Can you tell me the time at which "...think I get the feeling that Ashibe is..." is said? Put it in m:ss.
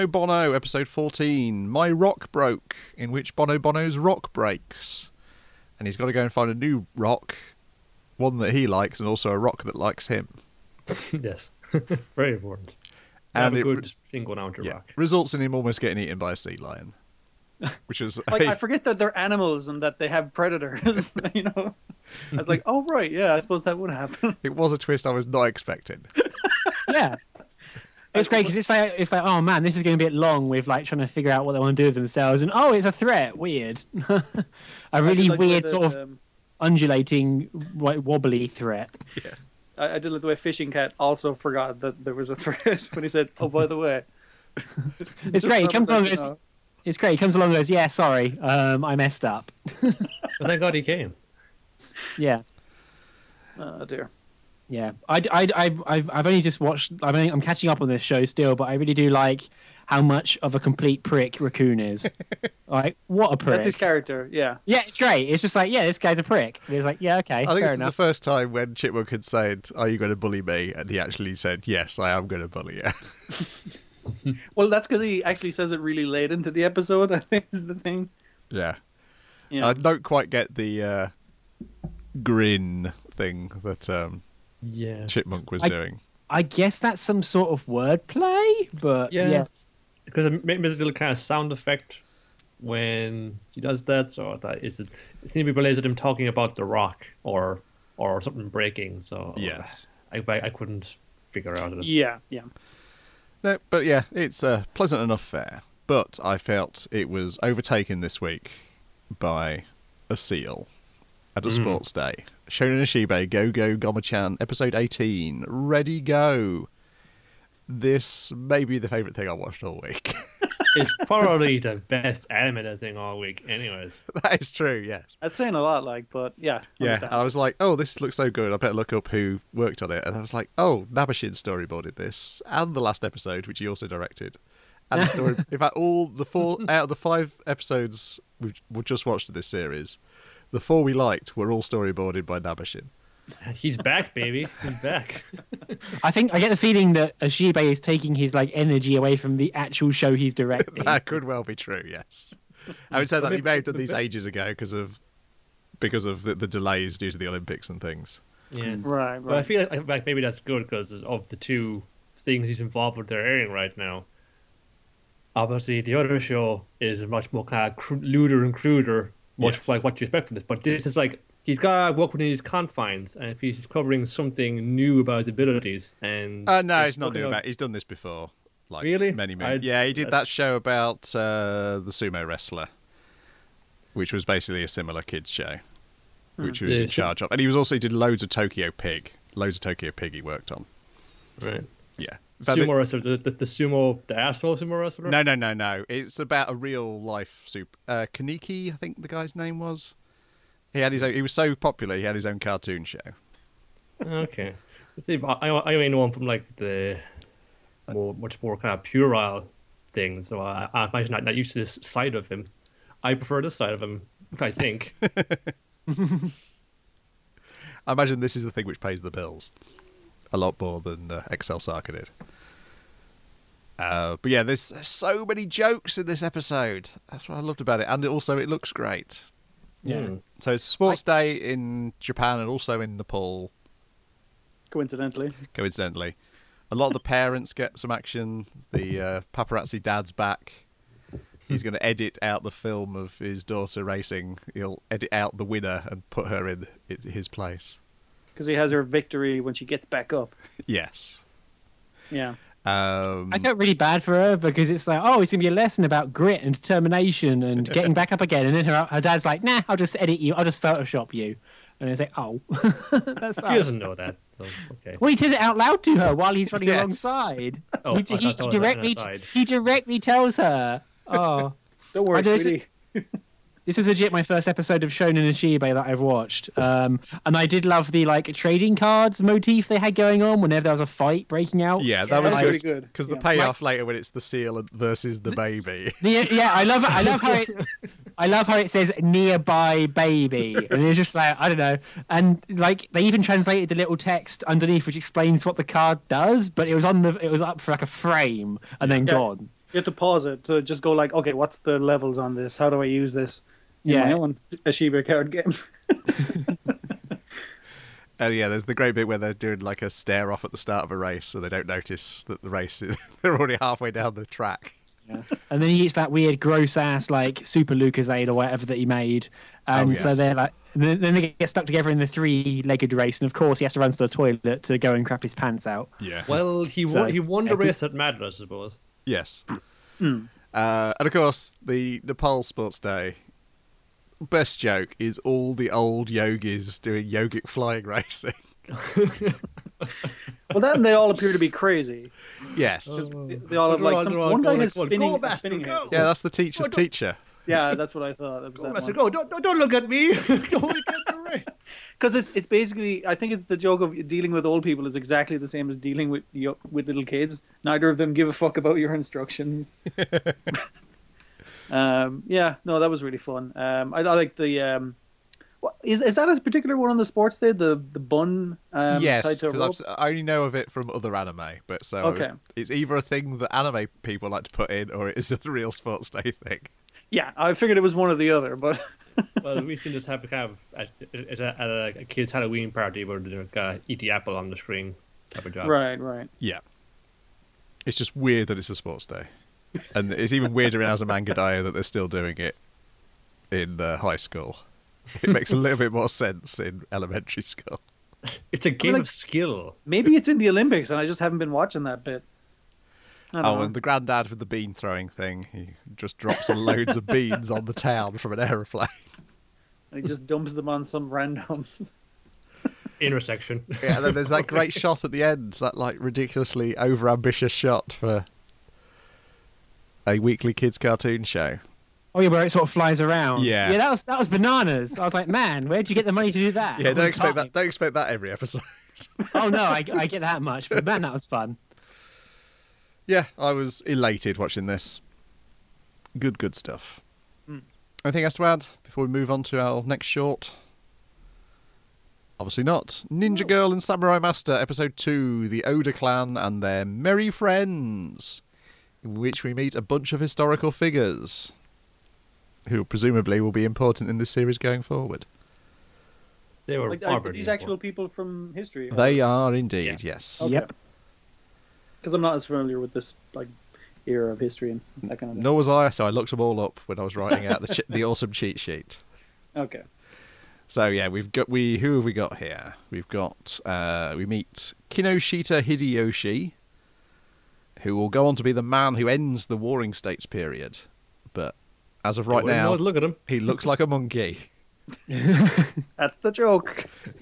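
2:26.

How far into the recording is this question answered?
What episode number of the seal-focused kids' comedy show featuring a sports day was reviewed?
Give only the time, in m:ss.
1:54.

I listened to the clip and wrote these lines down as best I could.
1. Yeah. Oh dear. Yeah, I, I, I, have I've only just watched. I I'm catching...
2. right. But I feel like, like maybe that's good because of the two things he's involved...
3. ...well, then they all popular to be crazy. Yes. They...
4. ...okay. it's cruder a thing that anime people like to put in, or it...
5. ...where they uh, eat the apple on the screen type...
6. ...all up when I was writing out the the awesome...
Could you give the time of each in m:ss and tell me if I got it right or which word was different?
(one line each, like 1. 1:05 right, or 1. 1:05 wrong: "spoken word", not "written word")
1. 0:52 right
2. 2:39 right
3. 5:40 wrong: "appear", not "popular"
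4. 6:11 wrong: "either", not "cruder"
5. 6:23 right
6. 7:46 right.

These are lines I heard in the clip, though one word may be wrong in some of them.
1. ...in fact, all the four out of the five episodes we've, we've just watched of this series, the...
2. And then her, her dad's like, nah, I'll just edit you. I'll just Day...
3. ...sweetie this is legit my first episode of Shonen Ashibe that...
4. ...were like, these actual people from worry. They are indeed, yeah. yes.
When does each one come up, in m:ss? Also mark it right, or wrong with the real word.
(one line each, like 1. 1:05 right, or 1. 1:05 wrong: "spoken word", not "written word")
1. 2:15 right
2. 4:18 wrong: "Photoshop", not "Day"
3. 4:32 right
4. 7:36 wrong: "history", not "worry".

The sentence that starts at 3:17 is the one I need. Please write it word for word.
Uh, Kaniki, I think the guy's name was.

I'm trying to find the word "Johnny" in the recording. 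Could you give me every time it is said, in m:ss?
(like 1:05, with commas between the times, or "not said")
not said.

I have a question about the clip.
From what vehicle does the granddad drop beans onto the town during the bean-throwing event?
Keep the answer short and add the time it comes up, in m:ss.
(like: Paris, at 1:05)
An aeroplane, at 6:48.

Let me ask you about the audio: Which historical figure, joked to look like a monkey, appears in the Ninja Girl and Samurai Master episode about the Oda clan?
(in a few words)
Kinoshita Hideyoshi.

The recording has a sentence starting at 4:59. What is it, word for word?
gone you have to pause it to just go like, okay, what's the levels on this?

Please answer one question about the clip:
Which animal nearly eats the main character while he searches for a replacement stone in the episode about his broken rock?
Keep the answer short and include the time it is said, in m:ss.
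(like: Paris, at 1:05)
Sea lion, at 0:16.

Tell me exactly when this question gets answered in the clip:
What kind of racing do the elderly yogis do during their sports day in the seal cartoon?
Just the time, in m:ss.
5:37.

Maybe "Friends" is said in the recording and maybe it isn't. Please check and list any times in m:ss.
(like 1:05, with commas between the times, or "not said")
7:27.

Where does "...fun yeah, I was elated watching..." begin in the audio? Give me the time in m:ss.
7:11.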